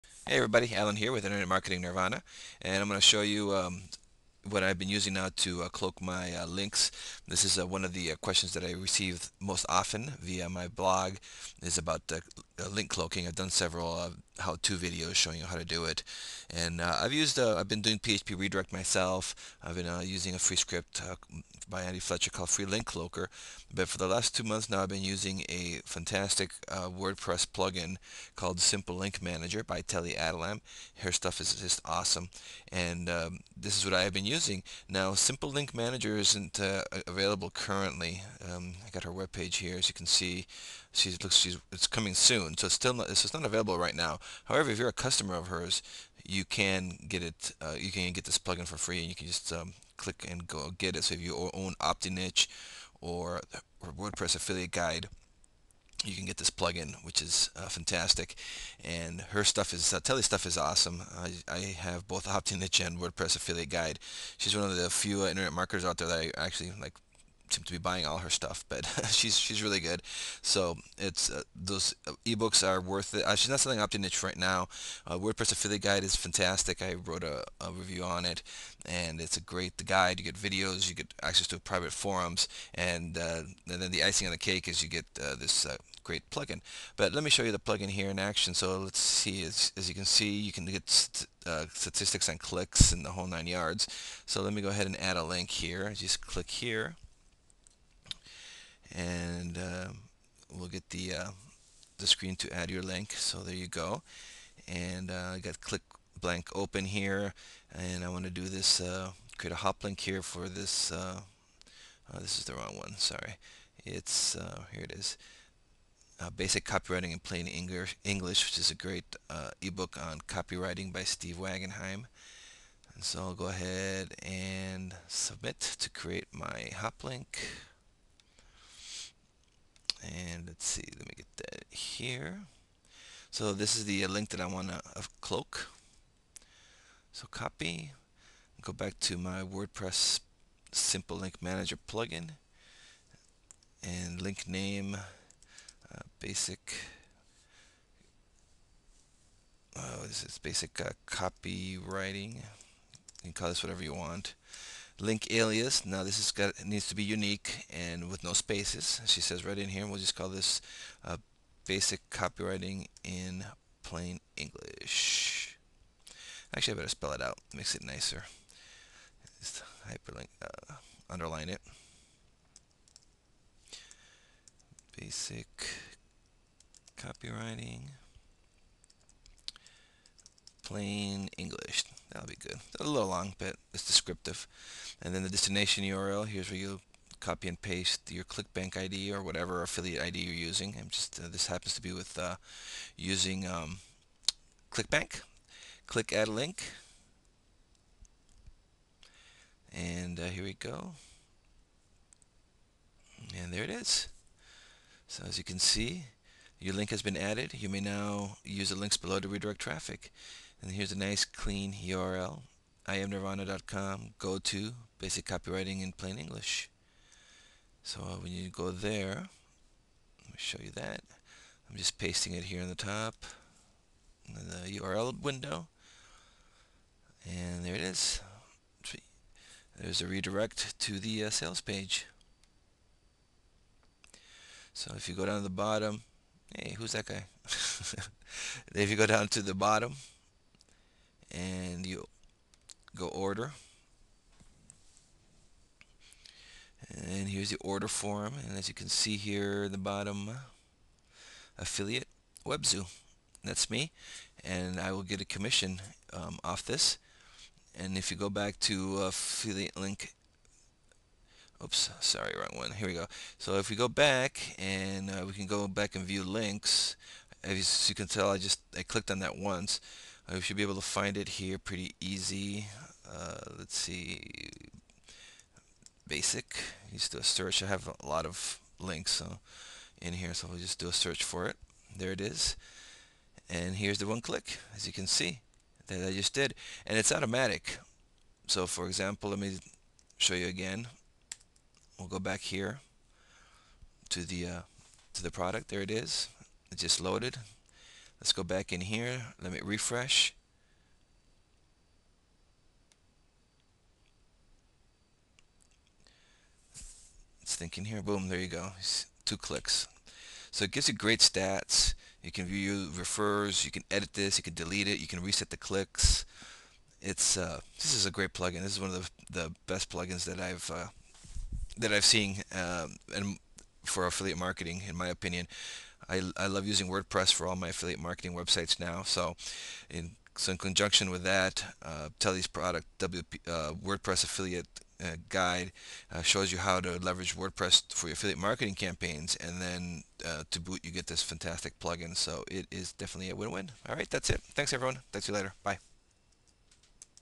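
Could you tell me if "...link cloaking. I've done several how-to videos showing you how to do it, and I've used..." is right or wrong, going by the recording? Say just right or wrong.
right.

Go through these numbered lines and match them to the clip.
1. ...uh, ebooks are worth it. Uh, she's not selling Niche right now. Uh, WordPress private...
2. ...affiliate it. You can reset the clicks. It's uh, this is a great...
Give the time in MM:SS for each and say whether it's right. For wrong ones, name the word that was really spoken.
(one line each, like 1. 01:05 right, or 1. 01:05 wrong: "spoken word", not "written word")
1. 01:12 wrong: "affiliate", not "private"
2. 05:14 wrong: "delete", not "affiliate".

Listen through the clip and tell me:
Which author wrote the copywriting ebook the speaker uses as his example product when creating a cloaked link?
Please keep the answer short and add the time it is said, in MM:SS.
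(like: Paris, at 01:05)
Steve Wagenheim, at 02:01.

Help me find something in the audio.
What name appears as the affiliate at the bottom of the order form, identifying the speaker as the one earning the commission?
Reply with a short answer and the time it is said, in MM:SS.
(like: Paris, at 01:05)
webzoo, at 04:12.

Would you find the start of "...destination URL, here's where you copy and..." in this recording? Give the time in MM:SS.
03:05.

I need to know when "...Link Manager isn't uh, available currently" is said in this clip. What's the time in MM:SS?
00:35.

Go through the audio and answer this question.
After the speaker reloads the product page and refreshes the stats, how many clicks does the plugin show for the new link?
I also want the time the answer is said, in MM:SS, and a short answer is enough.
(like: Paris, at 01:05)
2, at 05:09.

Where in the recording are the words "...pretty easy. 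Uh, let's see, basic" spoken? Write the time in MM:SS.
04:31.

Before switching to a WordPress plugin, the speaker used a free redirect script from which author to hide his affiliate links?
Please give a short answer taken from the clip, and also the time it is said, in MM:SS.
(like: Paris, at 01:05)
Andy Fletcher, at 00:21.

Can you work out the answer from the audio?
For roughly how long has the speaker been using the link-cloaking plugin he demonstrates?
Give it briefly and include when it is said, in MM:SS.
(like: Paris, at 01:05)
2 months, at 00:24.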